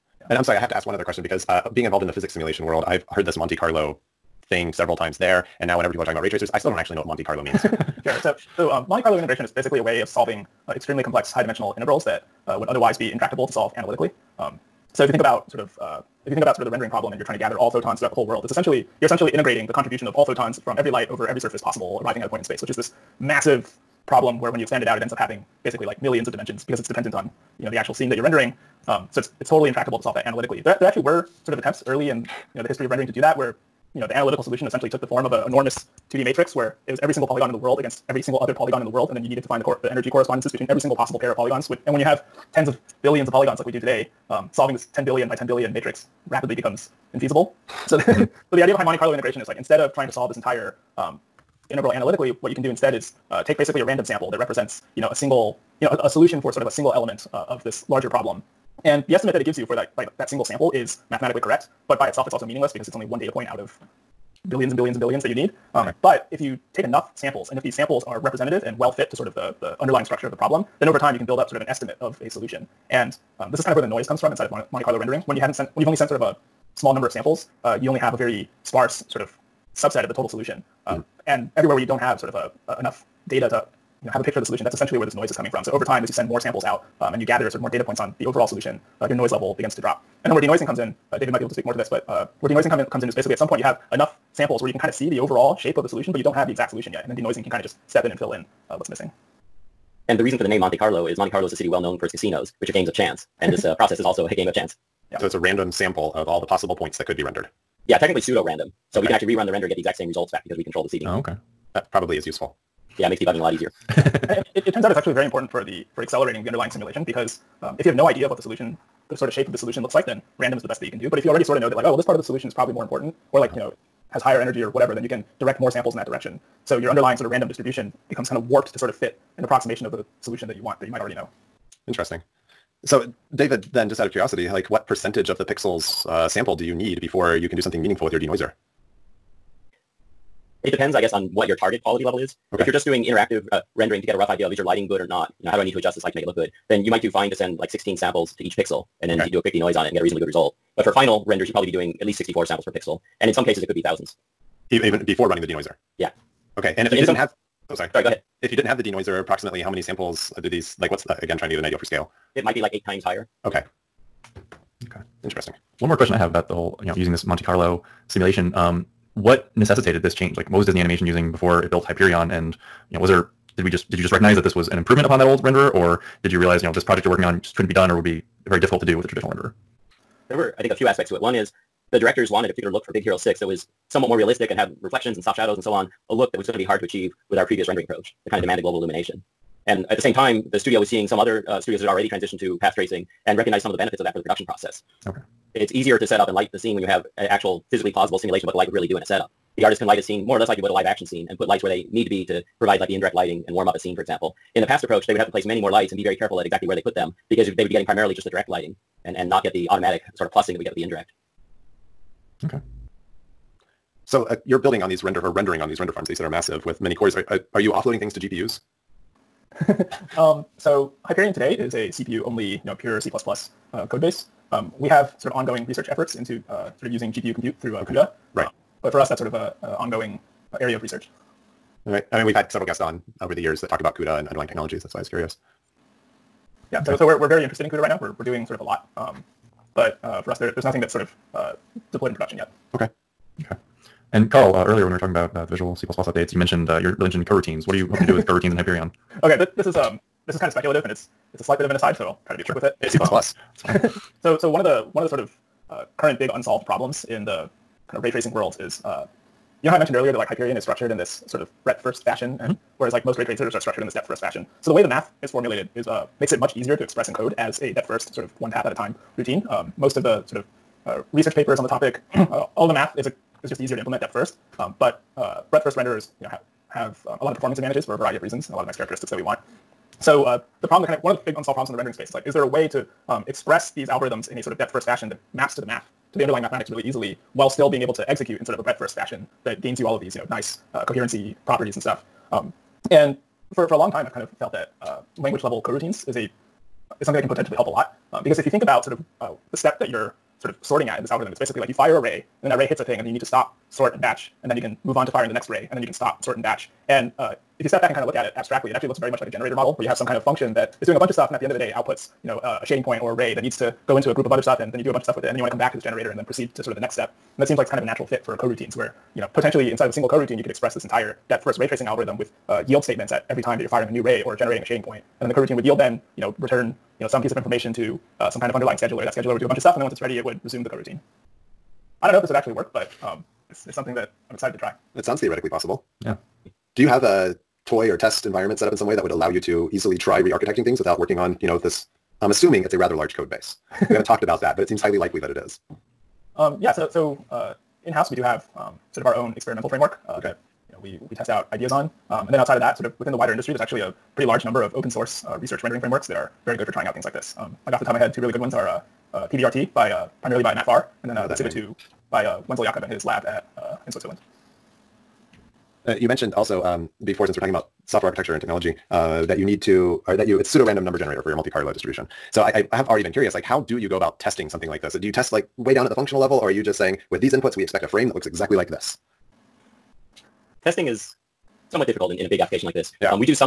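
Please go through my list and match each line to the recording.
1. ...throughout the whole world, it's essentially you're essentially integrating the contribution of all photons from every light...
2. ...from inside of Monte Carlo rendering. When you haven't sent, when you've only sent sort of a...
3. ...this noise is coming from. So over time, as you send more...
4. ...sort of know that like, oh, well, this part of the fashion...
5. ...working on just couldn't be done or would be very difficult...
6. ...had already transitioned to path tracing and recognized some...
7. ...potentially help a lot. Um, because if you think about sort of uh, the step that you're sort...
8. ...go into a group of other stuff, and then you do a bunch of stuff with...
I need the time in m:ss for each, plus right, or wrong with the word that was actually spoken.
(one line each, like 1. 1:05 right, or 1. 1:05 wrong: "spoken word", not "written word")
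1. 0:17 right
2. 1:14 right
3. 1:25 right
4. 2:01 wrong: "solution", not "fashion"
5. 2:57 right
6. 3:11 right
7. 4:57 right
8. 5:13 right.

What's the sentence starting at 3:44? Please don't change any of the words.
Um, we have sort of ongoing research efforts into uh, sort of using GPU compute through uh, okay.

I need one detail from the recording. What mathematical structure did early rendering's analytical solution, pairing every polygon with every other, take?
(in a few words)
2D matrix.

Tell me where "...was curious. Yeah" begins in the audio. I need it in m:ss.
3:55.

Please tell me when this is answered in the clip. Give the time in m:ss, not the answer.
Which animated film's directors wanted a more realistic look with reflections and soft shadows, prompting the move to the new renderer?
3:02.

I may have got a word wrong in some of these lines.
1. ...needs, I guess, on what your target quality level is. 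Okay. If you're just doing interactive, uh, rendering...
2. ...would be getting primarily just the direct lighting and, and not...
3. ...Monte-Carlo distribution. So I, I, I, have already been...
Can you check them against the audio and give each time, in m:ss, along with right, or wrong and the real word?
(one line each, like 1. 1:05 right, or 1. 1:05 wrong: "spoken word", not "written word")
1. 2:20 wrong: "depends", not "needs"
2. 3:27 right
3. 6:11 right.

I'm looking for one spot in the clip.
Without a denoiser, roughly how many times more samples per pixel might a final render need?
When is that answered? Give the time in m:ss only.
2:42.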